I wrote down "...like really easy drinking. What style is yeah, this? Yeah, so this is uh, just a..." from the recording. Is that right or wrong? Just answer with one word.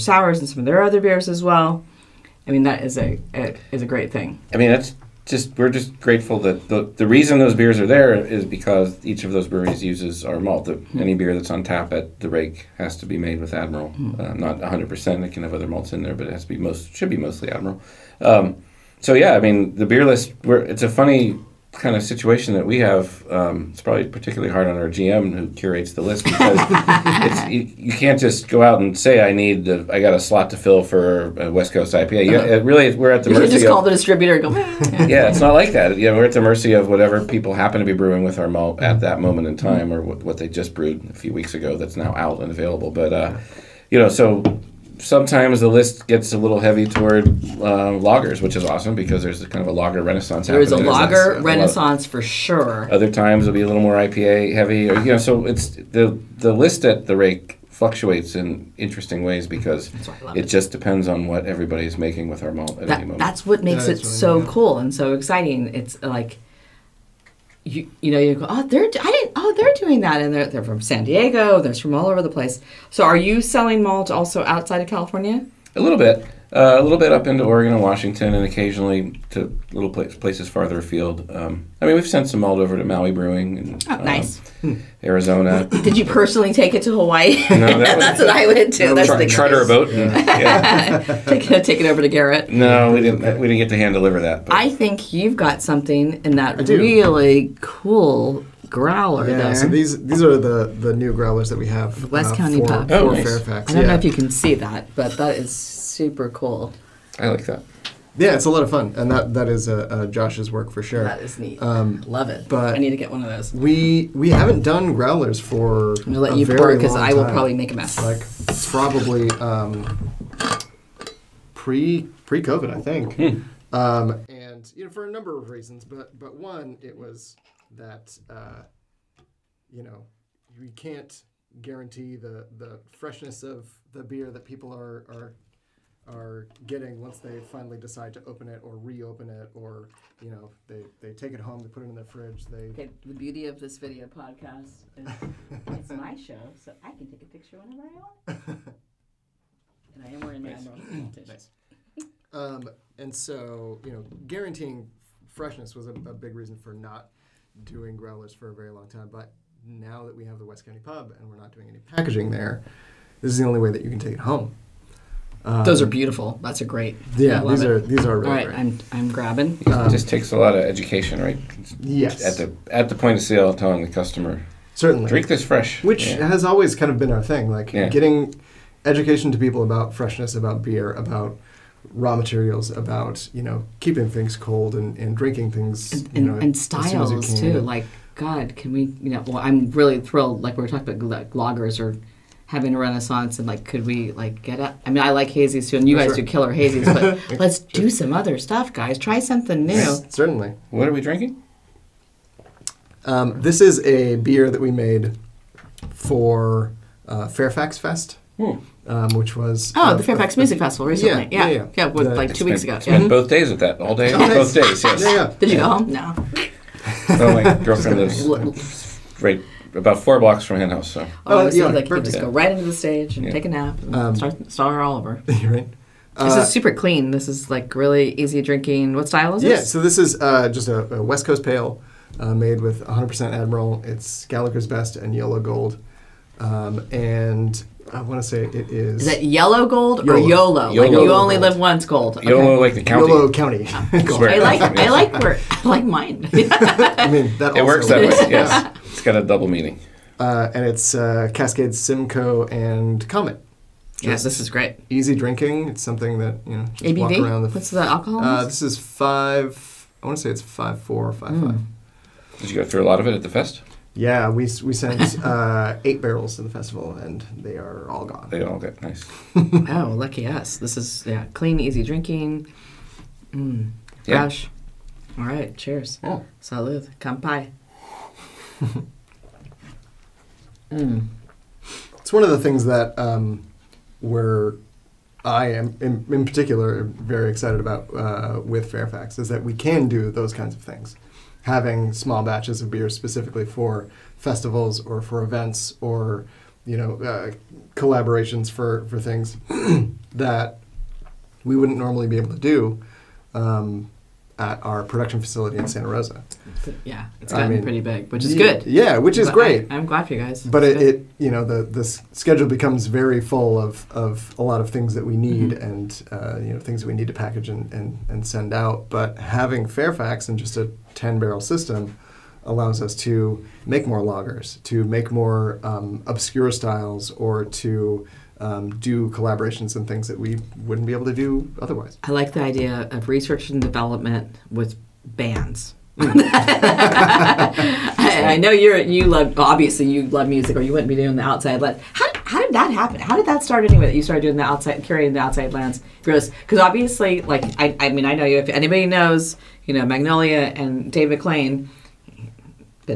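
right.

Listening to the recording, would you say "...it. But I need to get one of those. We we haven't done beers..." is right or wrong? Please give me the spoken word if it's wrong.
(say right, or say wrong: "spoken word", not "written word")
wrong: "growlers", not "beers".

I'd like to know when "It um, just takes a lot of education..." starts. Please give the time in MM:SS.
02:49.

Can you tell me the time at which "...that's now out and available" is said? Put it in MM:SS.
00:41.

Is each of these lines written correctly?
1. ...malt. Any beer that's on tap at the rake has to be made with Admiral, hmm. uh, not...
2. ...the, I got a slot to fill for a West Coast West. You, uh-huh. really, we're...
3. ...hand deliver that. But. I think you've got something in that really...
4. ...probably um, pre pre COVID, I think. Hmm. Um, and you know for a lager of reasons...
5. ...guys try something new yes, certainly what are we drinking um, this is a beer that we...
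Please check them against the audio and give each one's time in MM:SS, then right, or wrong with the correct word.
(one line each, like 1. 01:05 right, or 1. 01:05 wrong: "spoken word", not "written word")
1. 00:10 right
2. 00:29 wrong: "IPA", not "West"
3. 01:33 right
4. 01:58 wrong: "number", not "lager"
5. 03:18 right.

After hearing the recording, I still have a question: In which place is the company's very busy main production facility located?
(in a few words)
Santa Rosa.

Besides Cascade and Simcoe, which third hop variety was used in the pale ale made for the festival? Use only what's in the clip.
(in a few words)
Comet.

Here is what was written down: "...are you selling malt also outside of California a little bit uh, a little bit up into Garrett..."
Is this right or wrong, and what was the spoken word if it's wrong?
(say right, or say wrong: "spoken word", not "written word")
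wrong: "Oregon", not "Garrett".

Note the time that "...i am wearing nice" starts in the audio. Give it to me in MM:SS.
02:30.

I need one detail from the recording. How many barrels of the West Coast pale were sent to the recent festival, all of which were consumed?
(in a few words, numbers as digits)
8.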